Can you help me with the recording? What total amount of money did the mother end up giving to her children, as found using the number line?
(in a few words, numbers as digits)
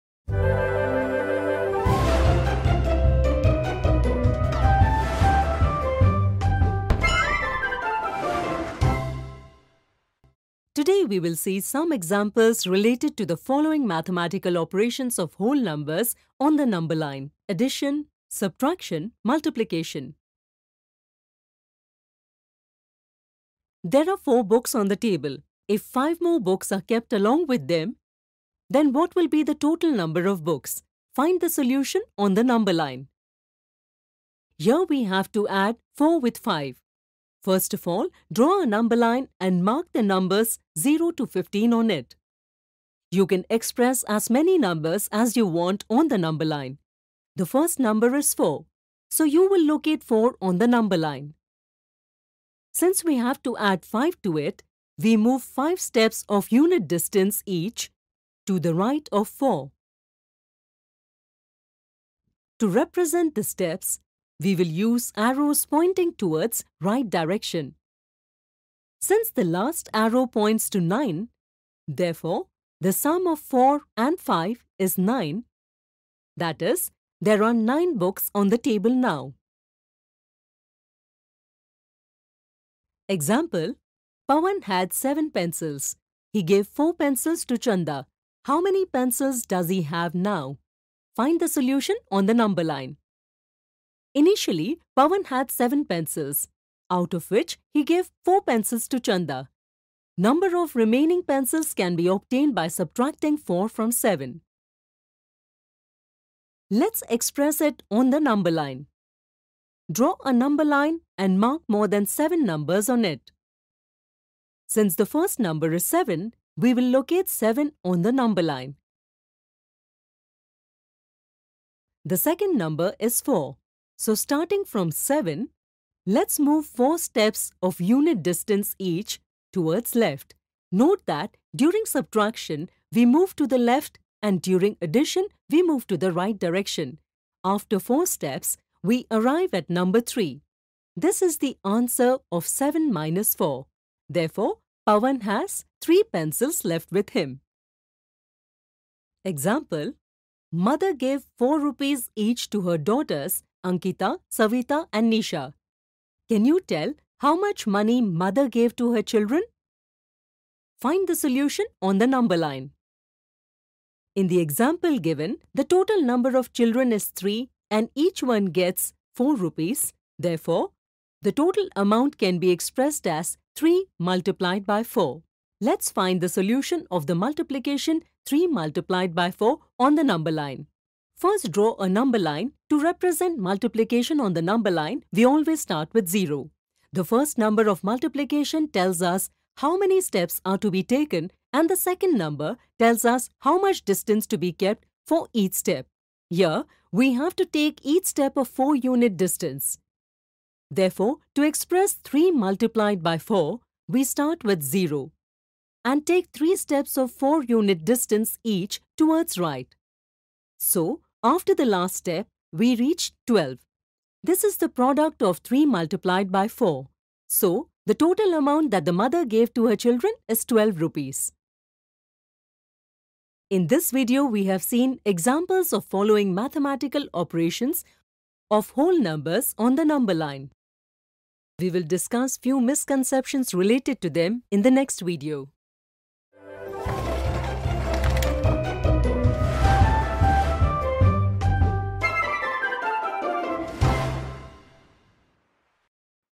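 12 rupees.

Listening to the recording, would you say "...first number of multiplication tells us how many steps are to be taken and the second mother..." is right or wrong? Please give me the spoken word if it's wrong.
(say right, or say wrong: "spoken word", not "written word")
wrong: "number", not "mother".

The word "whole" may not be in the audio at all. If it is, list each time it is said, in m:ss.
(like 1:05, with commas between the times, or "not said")
0:15, 3:48.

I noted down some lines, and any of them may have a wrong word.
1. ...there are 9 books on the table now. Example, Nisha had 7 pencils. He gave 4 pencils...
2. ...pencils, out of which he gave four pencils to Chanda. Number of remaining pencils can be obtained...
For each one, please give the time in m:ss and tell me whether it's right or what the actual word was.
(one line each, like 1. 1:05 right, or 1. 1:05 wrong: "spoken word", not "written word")
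1. 1:17 wrong: "Pawan", not "Nisha"
2. 1:35 right.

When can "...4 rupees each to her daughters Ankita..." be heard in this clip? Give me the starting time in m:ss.
2:31.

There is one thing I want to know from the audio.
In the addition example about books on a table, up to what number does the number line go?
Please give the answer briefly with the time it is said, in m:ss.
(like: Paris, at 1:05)
15, at 0:41.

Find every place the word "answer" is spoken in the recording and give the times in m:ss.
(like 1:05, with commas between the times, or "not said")
2:21.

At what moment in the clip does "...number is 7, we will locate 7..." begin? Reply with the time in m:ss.
1:55.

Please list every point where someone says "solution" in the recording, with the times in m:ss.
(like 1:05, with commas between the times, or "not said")
0:31, 1:31, 2:41, 2:56.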